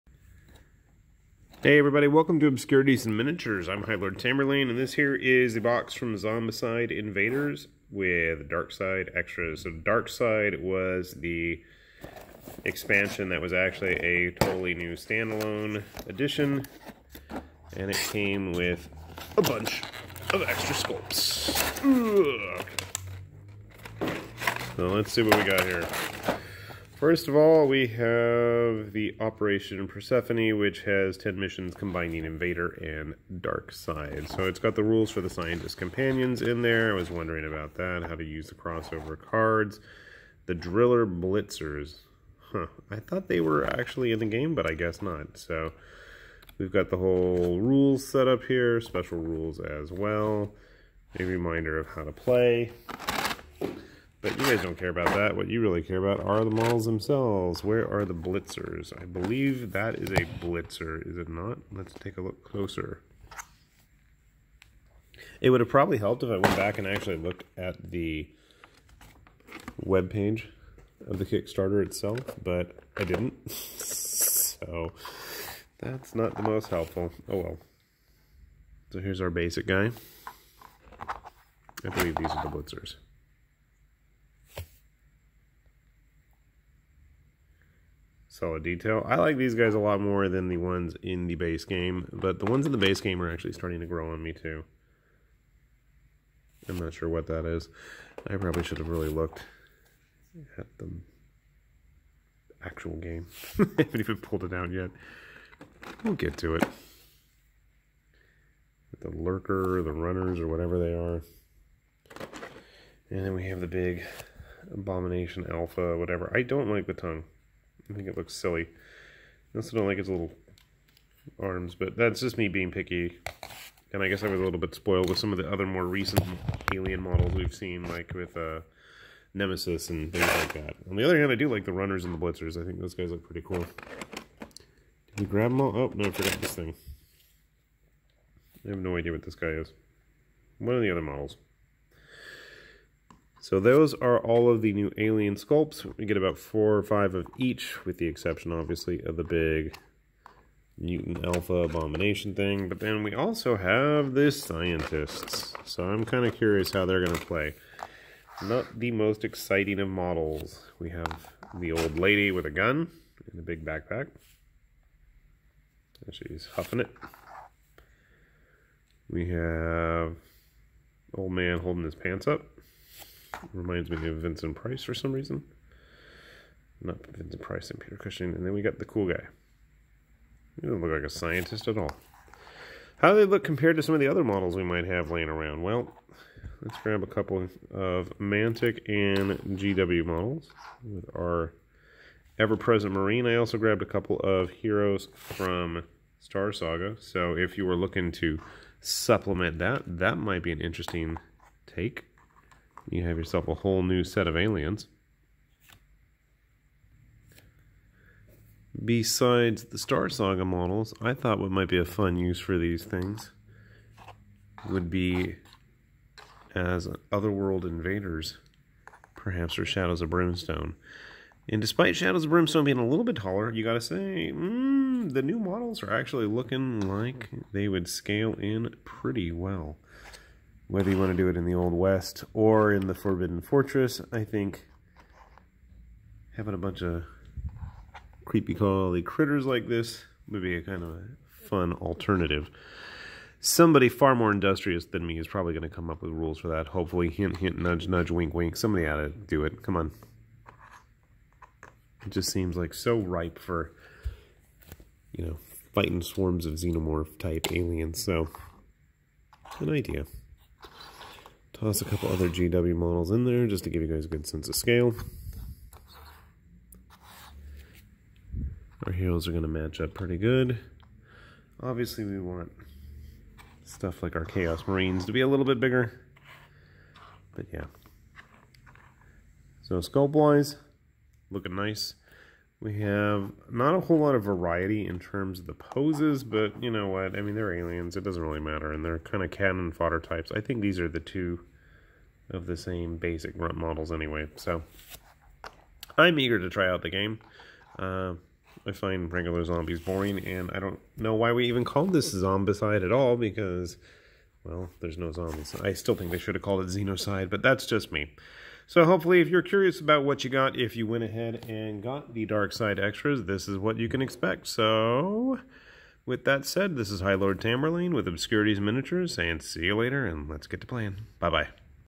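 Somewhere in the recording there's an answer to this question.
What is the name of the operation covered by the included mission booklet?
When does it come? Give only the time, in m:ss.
0:29.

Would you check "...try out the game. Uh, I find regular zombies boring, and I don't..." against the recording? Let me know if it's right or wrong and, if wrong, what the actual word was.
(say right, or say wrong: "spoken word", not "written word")
right.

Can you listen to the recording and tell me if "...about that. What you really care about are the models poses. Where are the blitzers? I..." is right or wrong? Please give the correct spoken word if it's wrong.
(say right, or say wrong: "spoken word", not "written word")
wrong: "themselves", not "poses".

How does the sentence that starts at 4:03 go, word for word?
Somebody far more industrious than me is probably going to come up with rules for that, hopefully.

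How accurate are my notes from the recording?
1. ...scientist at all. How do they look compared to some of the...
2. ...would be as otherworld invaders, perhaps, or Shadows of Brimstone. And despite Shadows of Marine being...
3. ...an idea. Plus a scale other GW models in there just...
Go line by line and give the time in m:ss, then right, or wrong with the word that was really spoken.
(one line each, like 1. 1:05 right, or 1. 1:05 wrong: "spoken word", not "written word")
1. 3:01 right
2. 3:34 wrong: "Brimstone", not "Marine"
3. 4:19 wrong: "couple", not "scale".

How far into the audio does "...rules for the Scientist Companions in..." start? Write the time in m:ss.
0:34.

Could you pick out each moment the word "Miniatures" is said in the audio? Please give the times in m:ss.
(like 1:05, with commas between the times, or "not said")
0:03, 5:18.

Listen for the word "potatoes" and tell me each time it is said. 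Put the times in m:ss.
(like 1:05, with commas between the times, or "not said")
not said.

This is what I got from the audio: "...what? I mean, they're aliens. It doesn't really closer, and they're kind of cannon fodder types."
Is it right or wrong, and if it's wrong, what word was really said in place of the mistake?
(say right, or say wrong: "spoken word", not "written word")
wrong: "matter", not "closer".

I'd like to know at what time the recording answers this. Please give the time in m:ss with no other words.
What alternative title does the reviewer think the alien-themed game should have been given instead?
5:06.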